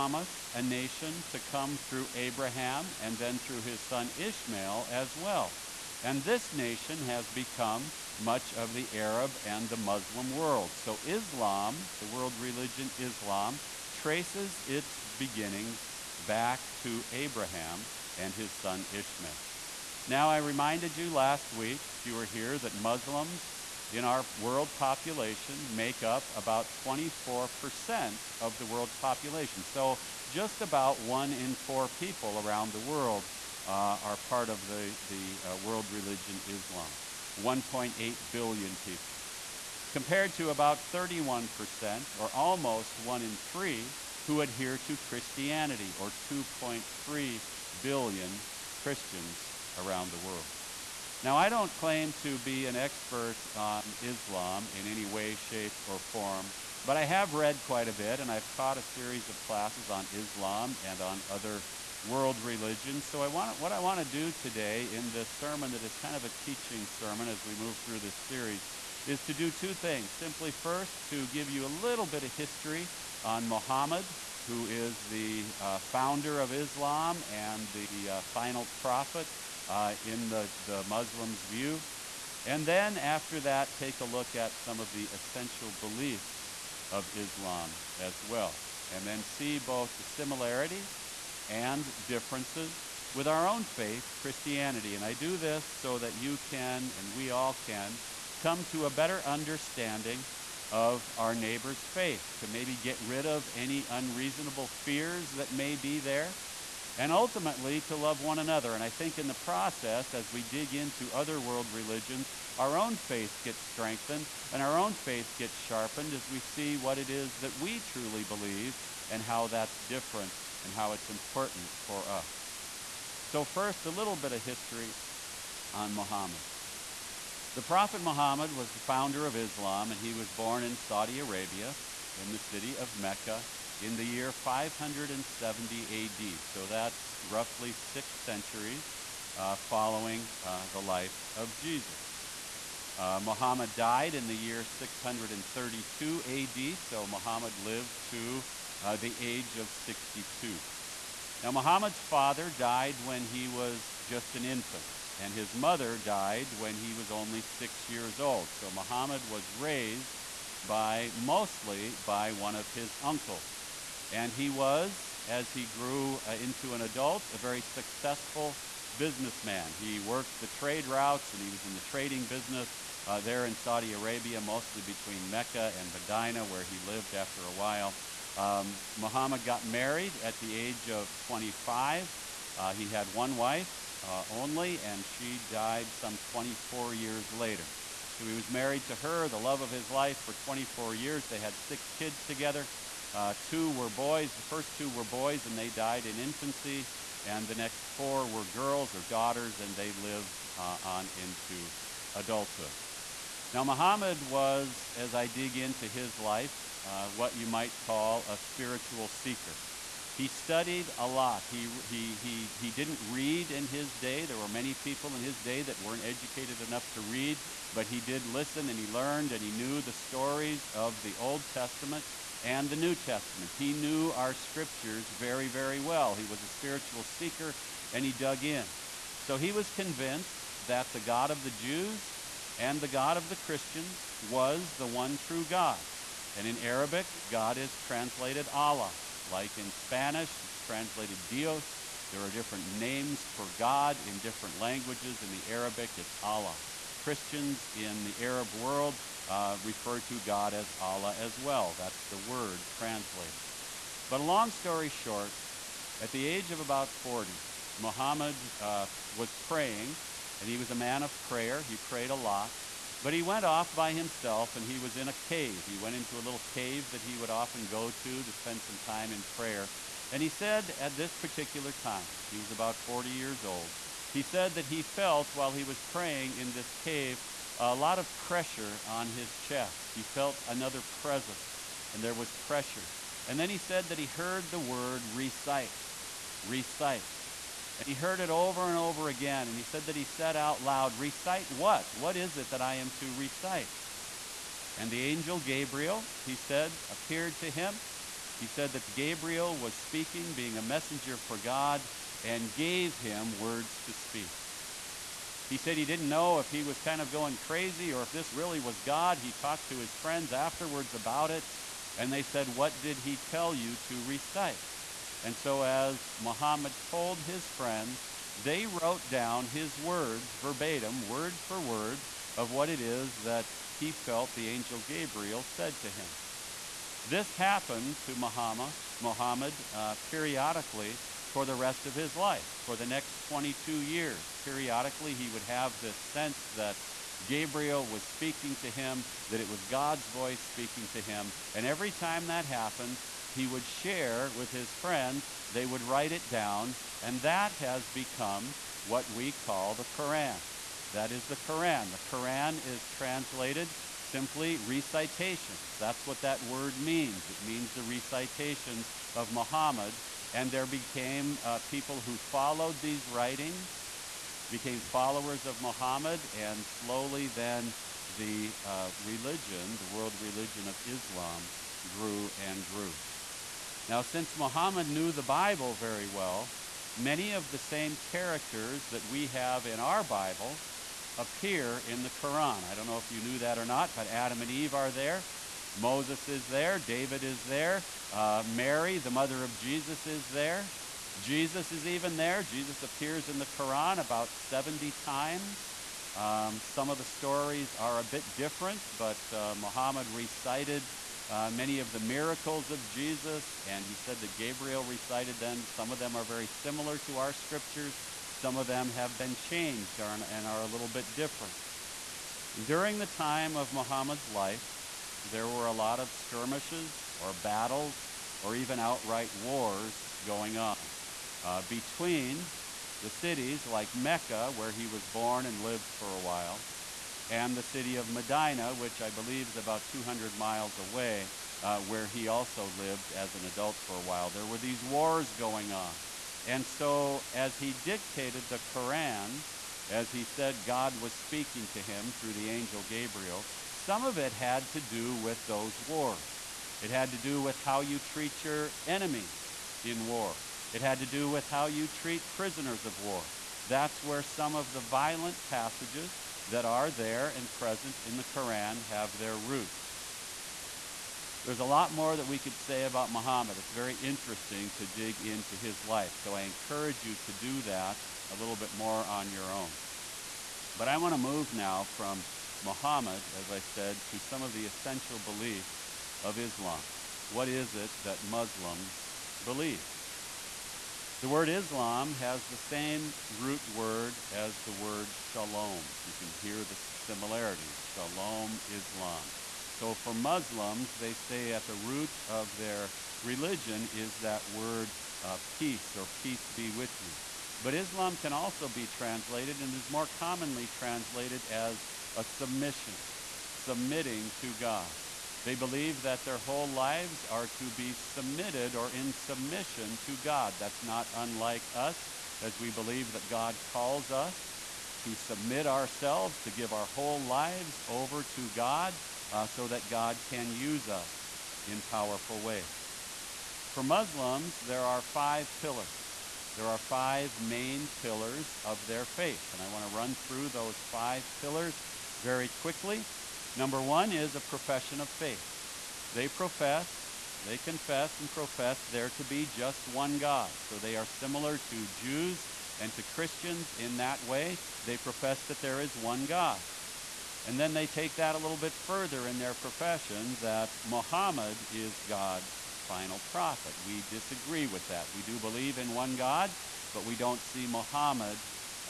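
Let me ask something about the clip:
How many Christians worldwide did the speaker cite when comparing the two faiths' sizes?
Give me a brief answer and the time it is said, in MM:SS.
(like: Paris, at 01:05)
2.3 billion, at 00:46.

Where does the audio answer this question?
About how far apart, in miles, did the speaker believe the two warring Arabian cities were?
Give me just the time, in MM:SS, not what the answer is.
07:09.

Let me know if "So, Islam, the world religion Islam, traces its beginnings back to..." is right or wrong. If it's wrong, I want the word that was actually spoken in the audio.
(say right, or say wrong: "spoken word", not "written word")
right.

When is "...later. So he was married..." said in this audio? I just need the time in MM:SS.
03:07.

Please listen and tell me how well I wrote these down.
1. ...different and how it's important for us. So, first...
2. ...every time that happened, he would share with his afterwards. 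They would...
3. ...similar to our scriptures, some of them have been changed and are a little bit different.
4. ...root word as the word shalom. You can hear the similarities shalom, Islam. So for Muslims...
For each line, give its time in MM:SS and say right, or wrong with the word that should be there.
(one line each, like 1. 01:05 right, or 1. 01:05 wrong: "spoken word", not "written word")
1. 01:59 right
2. 05:41 wrong: "friends", not "afterwards"
3. 06:46 right
4. 08:03 right.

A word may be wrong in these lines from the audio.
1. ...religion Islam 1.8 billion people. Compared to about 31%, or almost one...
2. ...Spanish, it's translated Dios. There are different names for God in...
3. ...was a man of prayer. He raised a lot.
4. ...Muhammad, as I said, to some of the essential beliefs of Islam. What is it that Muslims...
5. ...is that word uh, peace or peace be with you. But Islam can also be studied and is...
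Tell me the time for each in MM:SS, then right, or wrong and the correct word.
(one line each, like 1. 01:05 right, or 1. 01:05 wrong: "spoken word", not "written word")
1. 00:35 right
2. 03:59 right
3. 04:20 wrong: "prayed", not "raised"
4. 07:52 right
5. 08:13 wrong: "translated", not "studied".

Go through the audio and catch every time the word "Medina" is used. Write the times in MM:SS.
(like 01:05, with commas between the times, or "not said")
02:55, 07:08.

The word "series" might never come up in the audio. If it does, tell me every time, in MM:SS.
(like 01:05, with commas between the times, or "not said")
00:58, 01:08.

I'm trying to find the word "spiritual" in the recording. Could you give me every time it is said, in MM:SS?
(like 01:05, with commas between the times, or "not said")
03:28, 03:46.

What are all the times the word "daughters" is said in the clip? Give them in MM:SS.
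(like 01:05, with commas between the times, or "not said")
03:19.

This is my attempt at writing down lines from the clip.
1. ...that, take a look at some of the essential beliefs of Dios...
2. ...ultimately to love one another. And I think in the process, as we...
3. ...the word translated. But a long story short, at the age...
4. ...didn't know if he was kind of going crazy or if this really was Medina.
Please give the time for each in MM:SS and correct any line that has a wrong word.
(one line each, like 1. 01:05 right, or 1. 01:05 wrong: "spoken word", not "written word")
1. 01:23 wrong: "Islam", not "Dios"
2. 01:47 right
3. 04:12 right
4. 05:05 wrong: "God", not "Medina".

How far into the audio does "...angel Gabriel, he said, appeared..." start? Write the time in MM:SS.
04:55.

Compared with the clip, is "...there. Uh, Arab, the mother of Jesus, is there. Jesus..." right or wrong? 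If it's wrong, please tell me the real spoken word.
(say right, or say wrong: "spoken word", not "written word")
wrong: "Mary", not "Arab".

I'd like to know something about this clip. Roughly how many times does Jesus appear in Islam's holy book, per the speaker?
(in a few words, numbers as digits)
About 70.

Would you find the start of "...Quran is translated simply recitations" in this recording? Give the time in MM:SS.
05:52.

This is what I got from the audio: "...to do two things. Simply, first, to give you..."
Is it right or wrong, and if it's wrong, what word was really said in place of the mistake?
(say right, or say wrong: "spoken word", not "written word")
right.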